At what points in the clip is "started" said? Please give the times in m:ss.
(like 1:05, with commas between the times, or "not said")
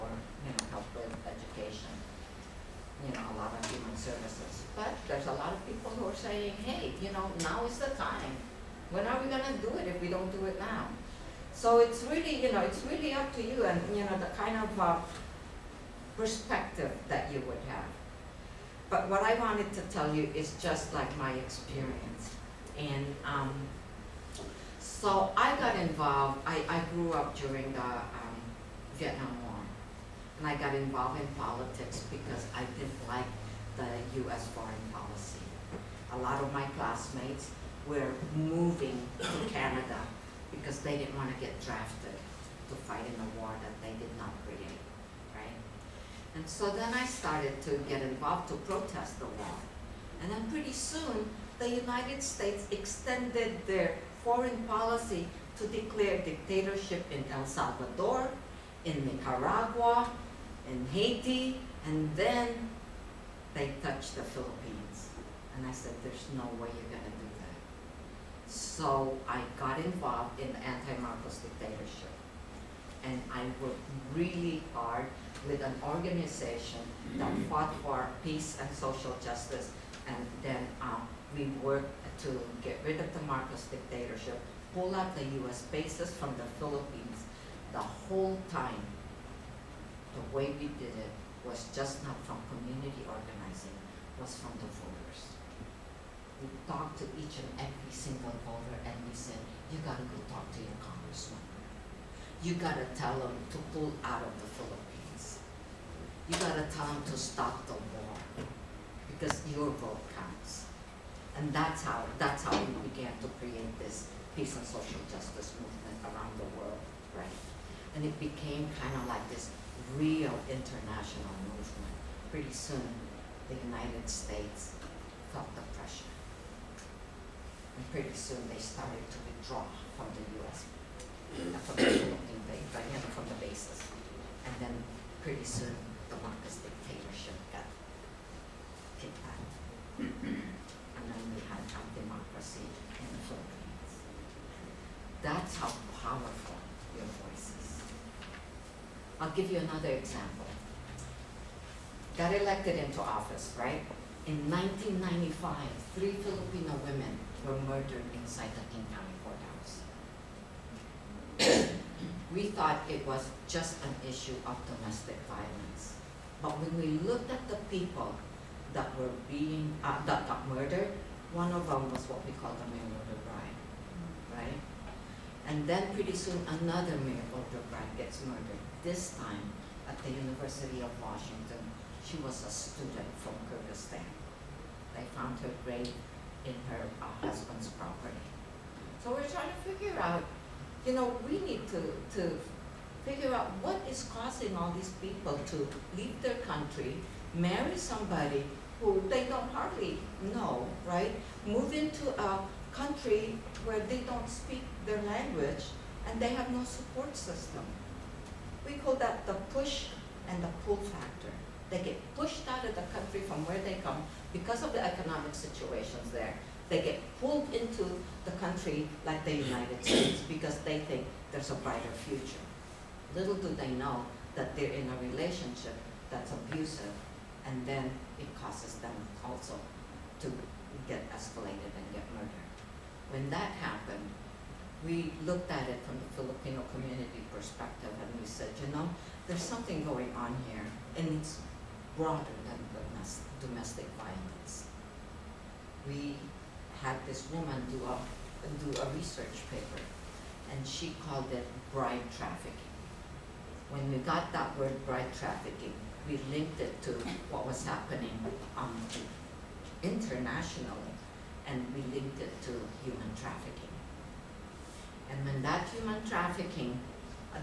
0:47, 2:08.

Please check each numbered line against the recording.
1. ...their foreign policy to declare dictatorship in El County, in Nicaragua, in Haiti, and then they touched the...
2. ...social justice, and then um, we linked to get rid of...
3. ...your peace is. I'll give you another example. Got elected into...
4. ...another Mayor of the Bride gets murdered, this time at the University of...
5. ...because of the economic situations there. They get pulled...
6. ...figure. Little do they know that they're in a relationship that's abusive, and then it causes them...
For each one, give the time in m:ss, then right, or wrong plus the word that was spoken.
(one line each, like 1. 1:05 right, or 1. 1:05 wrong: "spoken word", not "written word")
1. 0:53 wrong: "Salvador", not "County"
2. 1:18 wrong: "worked", not "linked"
3. 2:26 wrong: "voice", not "peace"
4. 2:56 right
5. 3:34 right
6. 3:42 wrong: "future", not "figure".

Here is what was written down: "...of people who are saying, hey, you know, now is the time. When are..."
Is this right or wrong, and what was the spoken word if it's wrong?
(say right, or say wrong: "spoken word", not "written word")
right.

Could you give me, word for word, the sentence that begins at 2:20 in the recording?
and then we had a democracy in the Philippines.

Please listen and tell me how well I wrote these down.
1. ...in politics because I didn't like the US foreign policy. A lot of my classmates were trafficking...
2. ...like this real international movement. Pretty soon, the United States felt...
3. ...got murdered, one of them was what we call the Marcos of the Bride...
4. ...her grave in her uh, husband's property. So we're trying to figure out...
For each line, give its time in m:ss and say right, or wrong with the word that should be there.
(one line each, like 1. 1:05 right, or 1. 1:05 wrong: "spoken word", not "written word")
1. 0:31 wrong: "moving", not "trafficking"
2. 1:59 right
3. 2:50 wrong: "Mayor", not "Marcos"
4. 3:05 right.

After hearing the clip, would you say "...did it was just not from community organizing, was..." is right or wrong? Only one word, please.
right.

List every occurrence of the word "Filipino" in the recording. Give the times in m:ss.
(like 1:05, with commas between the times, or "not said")
2:36, 3:56.